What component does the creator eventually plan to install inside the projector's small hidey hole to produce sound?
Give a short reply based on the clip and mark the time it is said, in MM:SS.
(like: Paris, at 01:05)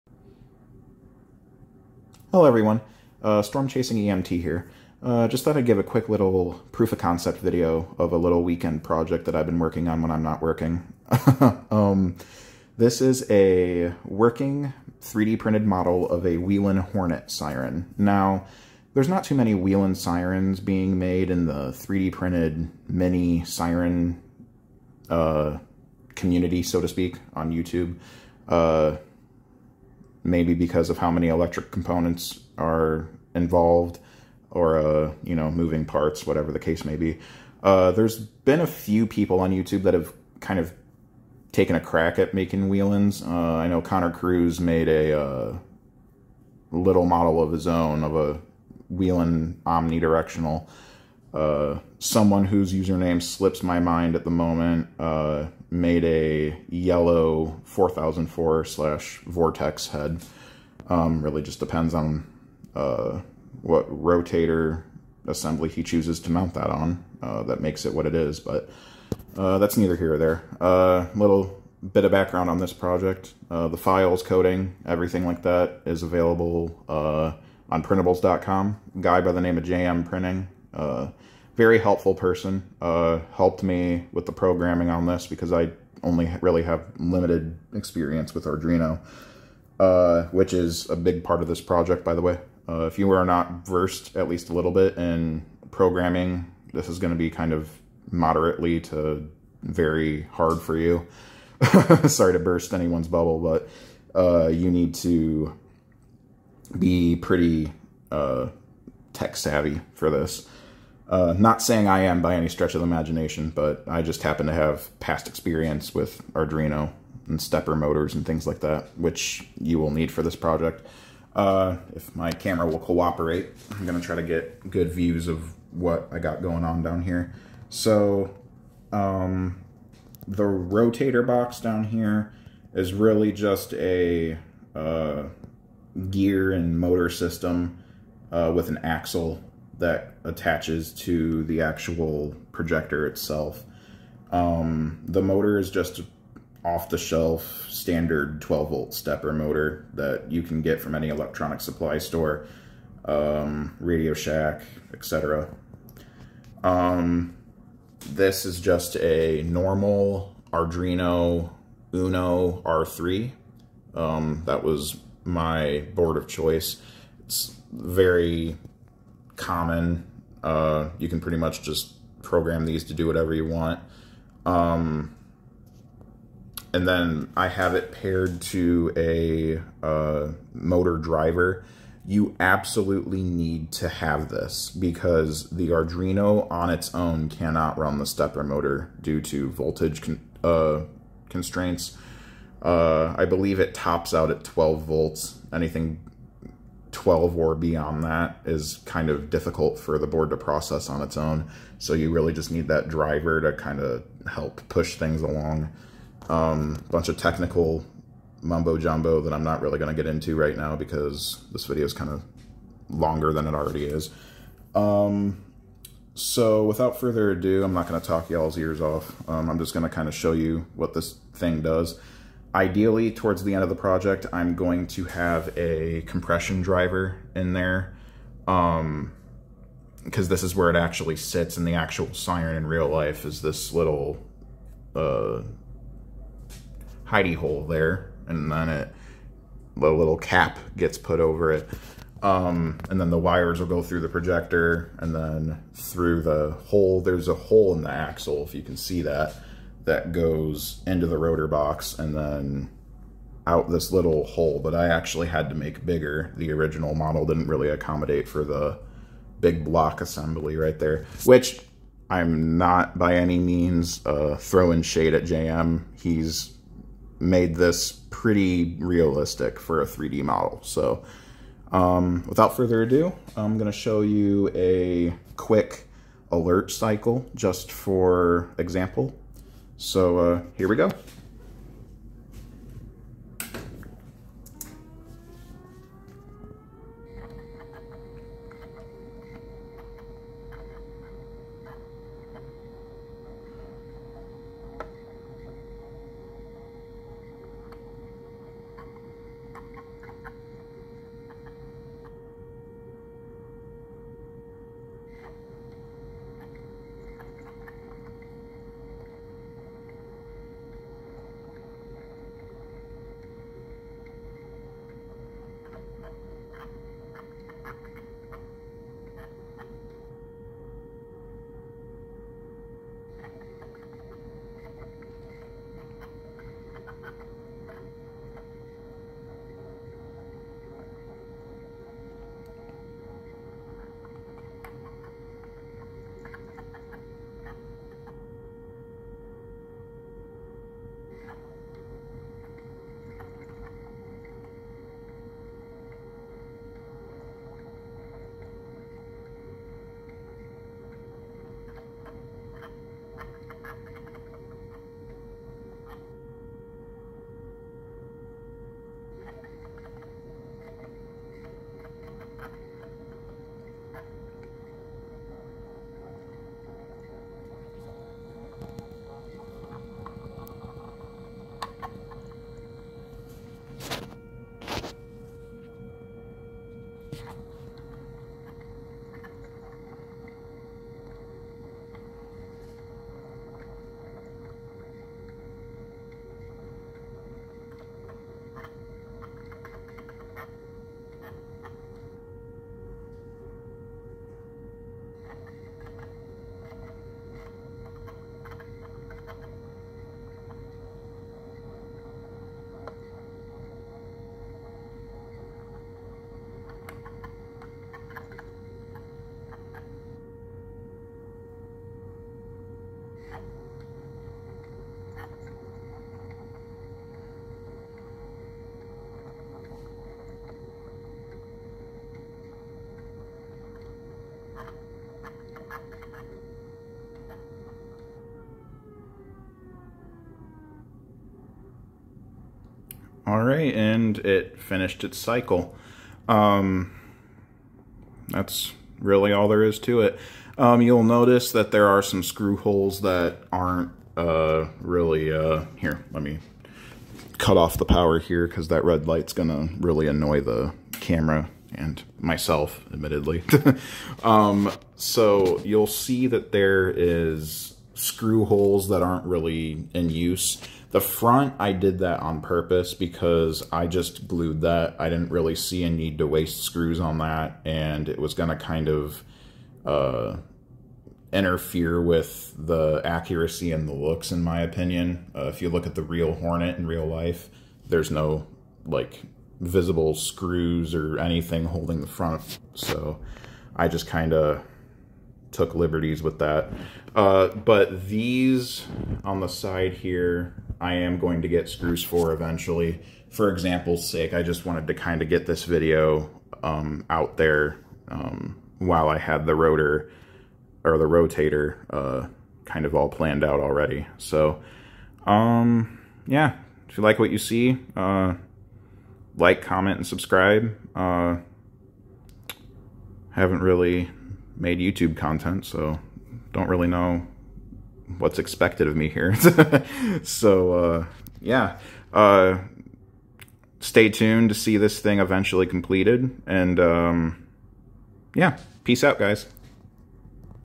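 compression driver, at 03:46.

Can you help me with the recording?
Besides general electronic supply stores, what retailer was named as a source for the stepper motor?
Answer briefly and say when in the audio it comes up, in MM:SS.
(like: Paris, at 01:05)
Radio Shack, at 02:33.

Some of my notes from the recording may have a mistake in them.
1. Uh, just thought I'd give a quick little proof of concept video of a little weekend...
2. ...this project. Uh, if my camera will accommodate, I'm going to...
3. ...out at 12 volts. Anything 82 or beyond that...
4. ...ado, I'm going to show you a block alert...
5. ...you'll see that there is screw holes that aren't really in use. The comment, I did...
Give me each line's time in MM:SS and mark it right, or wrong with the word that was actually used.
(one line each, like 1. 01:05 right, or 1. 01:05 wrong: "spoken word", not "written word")
1. 00:05 right
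2. 02:00 wrong: "cooperate", not "accommodate"
3. 03:14 wrong: "12", not "82"
4. 04:32 wrong: "quick", not "block"
5. 07:35 wrong: "front", not "comment".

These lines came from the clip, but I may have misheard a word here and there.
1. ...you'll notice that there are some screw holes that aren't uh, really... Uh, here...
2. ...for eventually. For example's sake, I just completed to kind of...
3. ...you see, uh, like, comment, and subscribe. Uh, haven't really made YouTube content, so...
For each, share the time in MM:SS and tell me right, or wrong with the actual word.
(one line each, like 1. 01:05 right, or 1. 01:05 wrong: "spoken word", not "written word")
1. 07:20 right
2. 08:12 wrong: "wanted", not "completed"
3. 08:27 right.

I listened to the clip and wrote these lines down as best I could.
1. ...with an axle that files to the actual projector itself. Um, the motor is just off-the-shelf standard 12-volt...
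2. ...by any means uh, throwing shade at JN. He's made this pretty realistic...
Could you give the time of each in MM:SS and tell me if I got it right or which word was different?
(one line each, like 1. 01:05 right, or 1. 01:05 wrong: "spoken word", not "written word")
1. 02:18 wrong: "attaches", not "files"
2. 04:22 right.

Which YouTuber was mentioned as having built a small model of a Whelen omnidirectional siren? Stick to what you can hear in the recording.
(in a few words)
Connor Cruz.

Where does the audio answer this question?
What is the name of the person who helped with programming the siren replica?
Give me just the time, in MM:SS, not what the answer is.
01:19.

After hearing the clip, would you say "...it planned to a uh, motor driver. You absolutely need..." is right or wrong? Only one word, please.
wrong.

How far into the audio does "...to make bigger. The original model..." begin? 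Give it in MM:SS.
04:15.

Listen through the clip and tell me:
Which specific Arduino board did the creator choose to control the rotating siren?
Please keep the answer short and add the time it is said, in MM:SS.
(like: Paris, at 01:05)
Arduino Uno R3, at 02:40.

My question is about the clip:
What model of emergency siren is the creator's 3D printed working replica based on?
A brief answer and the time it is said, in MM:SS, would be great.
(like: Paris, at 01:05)
Whelen Hornet, at 00:16.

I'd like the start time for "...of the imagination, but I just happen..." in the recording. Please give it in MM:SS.
01:52.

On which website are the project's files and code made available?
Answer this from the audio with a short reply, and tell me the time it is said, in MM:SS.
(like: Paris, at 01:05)
printables.com, at 01:17.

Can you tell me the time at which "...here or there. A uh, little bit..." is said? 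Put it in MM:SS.
01:09.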